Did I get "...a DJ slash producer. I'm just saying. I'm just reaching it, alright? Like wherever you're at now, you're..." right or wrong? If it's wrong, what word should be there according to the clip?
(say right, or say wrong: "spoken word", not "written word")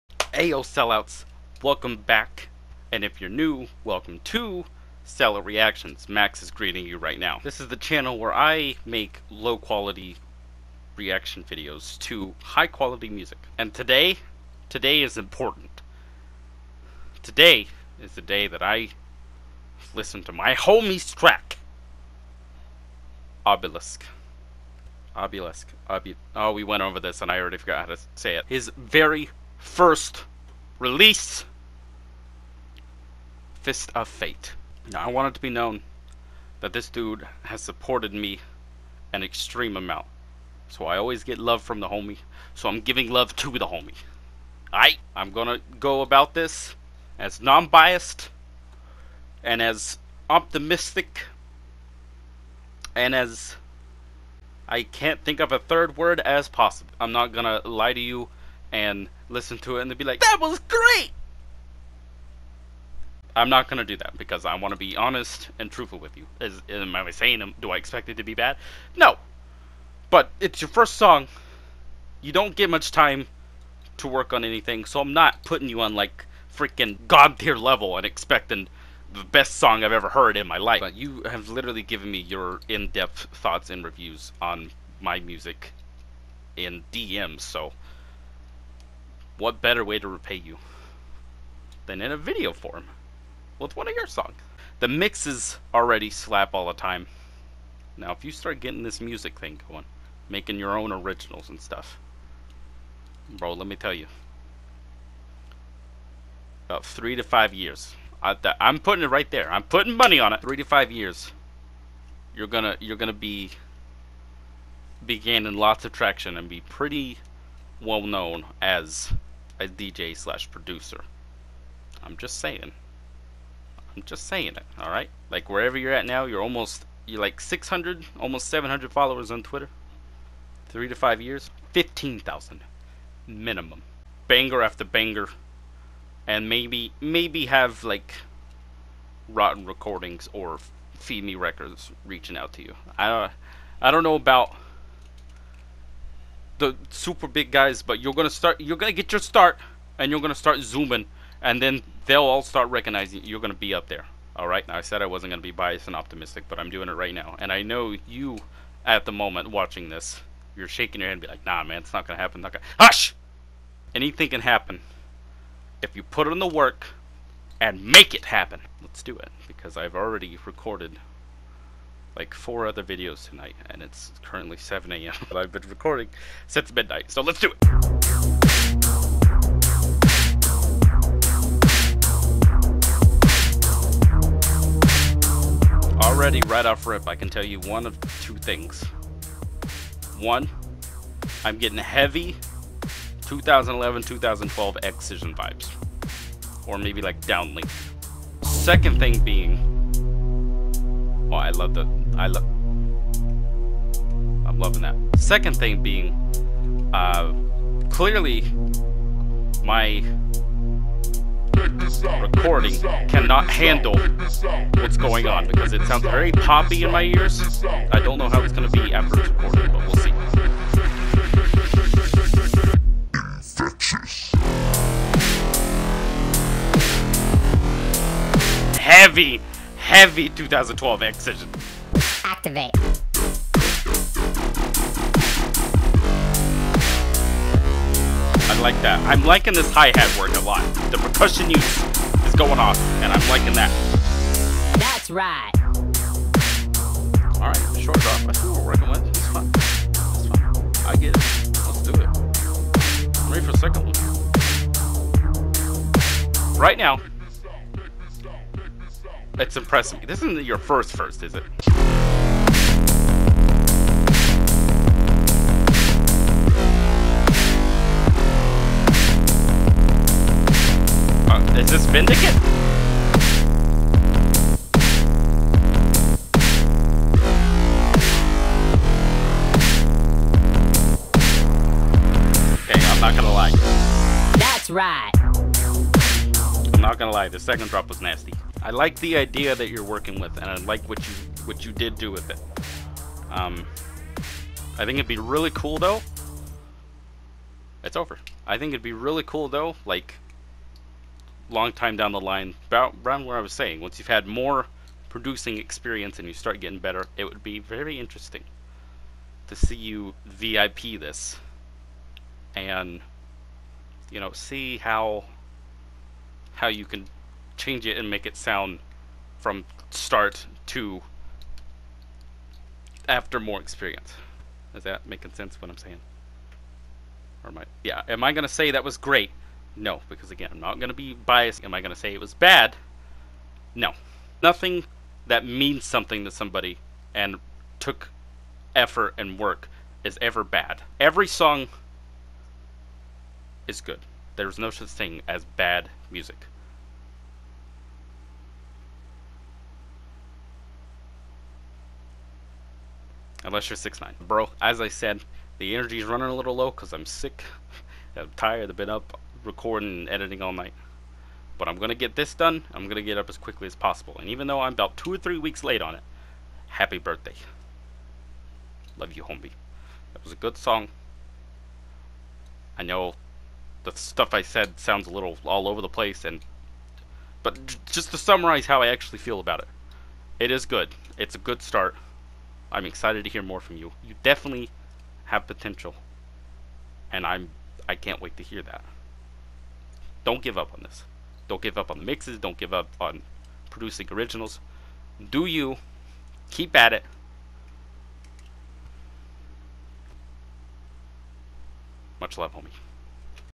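wrong: "saying", not "reaching".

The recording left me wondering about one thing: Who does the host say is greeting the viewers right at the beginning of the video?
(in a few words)
Max.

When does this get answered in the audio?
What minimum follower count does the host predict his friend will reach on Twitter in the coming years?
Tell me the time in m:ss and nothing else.
2:11.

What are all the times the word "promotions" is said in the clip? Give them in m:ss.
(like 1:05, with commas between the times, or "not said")
not said.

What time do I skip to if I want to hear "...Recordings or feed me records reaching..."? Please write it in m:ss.
2:19.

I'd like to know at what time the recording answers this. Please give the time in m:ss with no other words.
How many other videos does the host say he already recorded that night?
2:52.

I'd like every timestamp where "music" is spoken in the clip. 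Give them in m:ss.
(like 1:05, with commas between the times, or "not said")
0:13, 1:25, 1:39, 5:46.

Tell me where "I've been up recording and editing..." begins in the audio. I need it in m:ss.
5:58.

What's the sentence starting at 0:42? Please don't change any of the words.
So I'm giving love to the homie.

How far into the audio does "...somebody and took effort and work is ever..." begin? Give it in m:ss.
5:36.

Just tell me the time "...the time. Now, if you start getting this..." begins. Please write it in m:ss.
1:36.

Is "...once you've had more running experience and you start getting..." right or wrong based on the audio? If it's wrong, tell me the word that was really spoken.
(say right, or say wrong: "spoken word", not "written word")
wrong: "producing", not "running".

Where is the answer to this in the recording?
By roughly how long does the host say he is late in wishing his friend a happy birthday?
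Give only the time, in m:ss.
6:04.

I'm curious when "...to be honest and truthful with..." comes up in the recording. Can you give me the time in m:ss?
1:04.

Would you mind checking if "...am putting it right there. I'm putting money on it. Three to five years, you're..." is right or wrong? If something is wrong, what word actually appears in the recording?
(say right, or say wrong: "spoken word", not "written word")
right.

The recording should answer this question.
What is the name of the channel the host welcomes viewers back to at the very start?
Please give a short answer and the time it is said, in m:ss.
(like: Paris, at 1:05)
Sellout Reactions, at 0:05.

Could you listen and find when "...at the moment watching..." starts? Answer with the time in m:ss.
2:38.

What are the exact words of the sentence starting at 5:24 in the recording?
Is that making sense what I'm saying?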